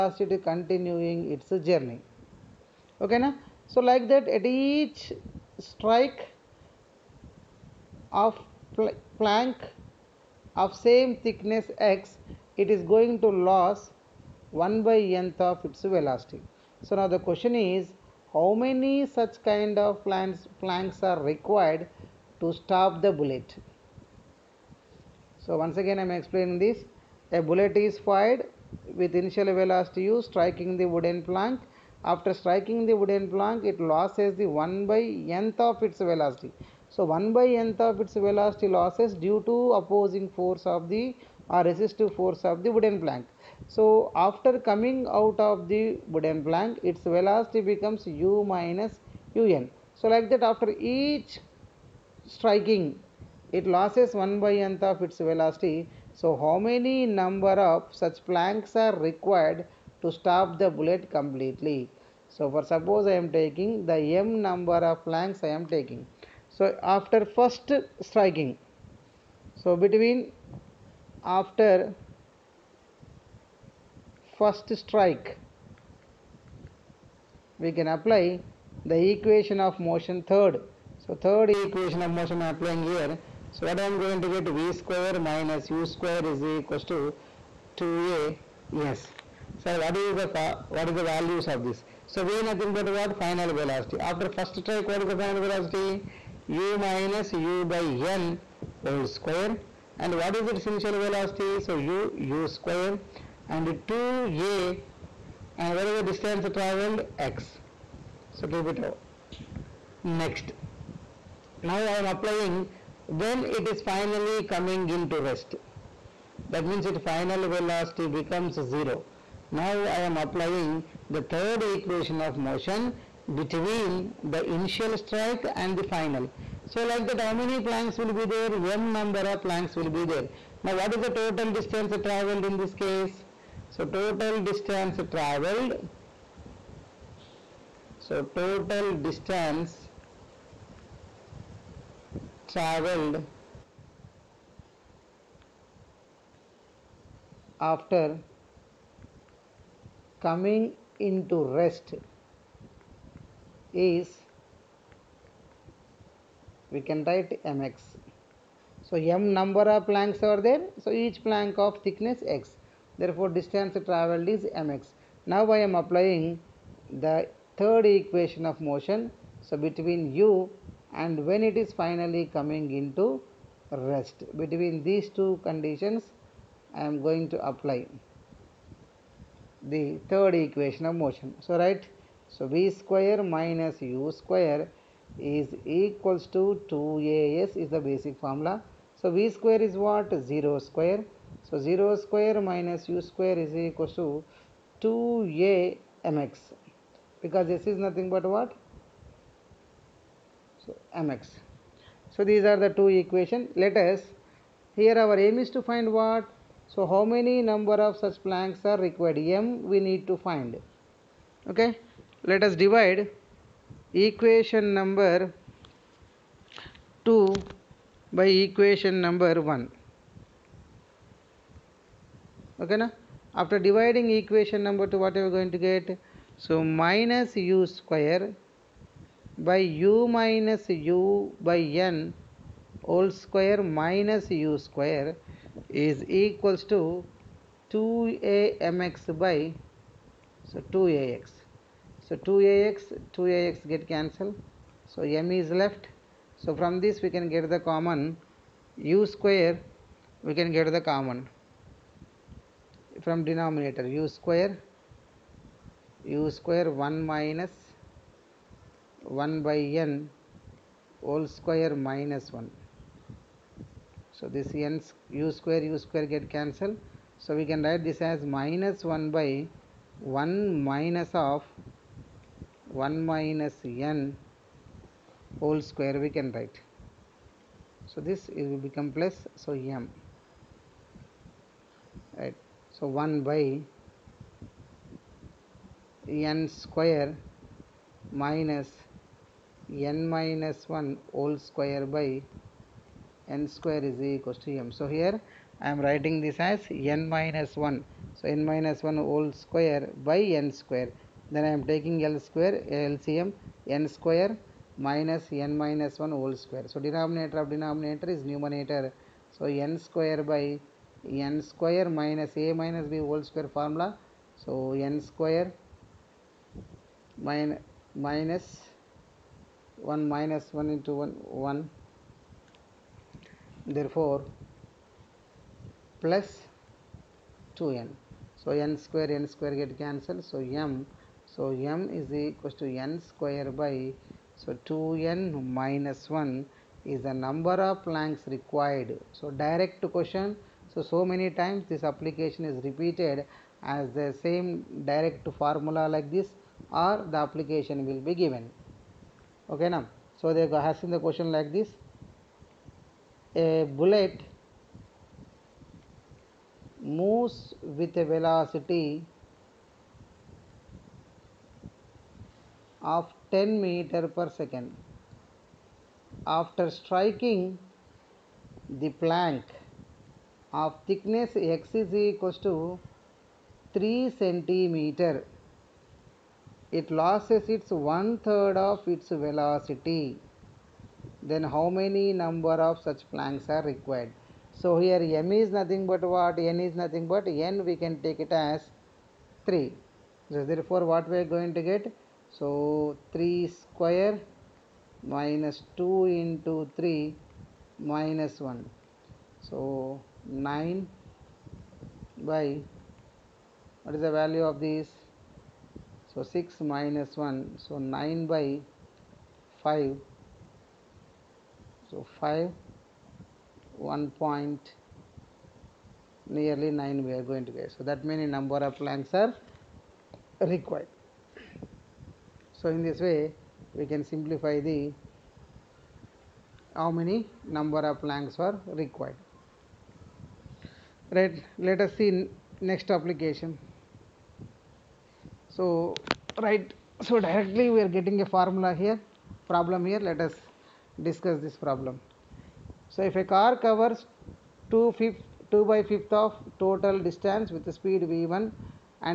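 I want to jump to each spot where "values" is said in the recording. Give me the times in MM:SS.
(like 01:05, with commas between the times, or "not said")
01:31, 06:44.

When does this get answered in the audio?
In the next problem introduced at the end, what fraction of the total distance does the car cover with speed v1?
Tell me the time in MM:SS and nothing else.
07:25.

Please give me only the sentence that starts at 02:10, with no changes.
Now what is the total distance travelled in this case?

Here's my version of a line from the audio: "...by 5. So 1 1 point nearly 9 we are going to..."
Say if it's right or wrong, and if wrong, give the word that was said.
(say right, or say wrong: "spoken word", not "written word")
wrong: "5", not "1".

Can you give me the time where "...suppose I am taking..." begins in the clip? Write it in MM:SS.
01:02.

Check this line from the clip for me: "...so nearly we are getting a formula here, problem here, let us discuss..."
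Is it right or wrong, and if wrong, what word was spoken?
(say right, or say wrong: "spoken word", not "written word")
wrong: "directly", not "nearly".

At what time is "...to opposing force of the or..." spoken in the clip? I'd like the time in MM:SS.
00:39.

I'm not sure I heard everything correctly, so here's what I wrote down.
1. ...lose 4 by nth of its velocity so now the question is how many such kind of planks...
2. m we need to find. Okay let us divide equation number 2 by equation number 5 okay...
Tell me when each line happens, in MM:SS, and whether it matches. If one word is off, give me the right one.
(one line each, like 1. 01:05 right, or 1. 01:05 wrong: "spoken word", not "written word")
1. 00:13 wrong: "1", not "4"
2. 03:29 wrong: "1", not "5".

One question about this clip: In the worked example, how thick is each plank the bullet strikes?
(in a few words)
3 centimeters.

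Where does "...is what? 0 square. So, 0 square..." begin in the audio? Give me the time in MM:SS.
03:09.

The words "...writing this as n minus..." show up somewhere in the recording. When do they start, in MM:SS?
04:55.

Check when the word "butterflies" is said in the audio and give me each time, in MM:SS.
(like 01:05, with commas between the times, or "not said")
not said.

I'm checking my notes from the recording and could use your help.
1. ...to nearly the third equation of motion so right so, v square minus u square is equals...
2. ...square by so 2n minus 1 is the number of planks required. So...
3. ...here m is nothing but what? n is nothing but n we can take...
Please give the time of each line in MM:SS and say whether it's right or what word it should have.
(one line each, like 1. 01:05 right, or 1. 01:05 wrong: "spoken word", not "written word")
1. 02:57 wrong: "apply", not "nearly"
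2. 05:33 right
3. 06:24 right.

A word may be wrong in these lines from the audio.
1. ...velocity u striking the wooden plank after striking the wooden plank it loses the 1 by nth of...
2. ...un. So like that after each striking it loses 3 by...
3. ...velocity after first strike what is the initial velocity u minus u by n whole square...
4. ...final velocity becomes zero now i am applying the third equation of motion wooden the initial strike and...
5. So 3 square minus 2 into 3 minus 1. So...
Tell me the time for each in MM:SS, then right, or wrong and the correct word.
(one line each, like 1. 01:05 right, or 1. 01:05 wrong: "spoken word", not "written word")
1. 00:29 right
2. 00:49 wrong: "1", not "3"
3. 01:33 wrong: "final", not "initial"
4. 01:57 wrong: "between", not "wooden"
5. 06:32 right.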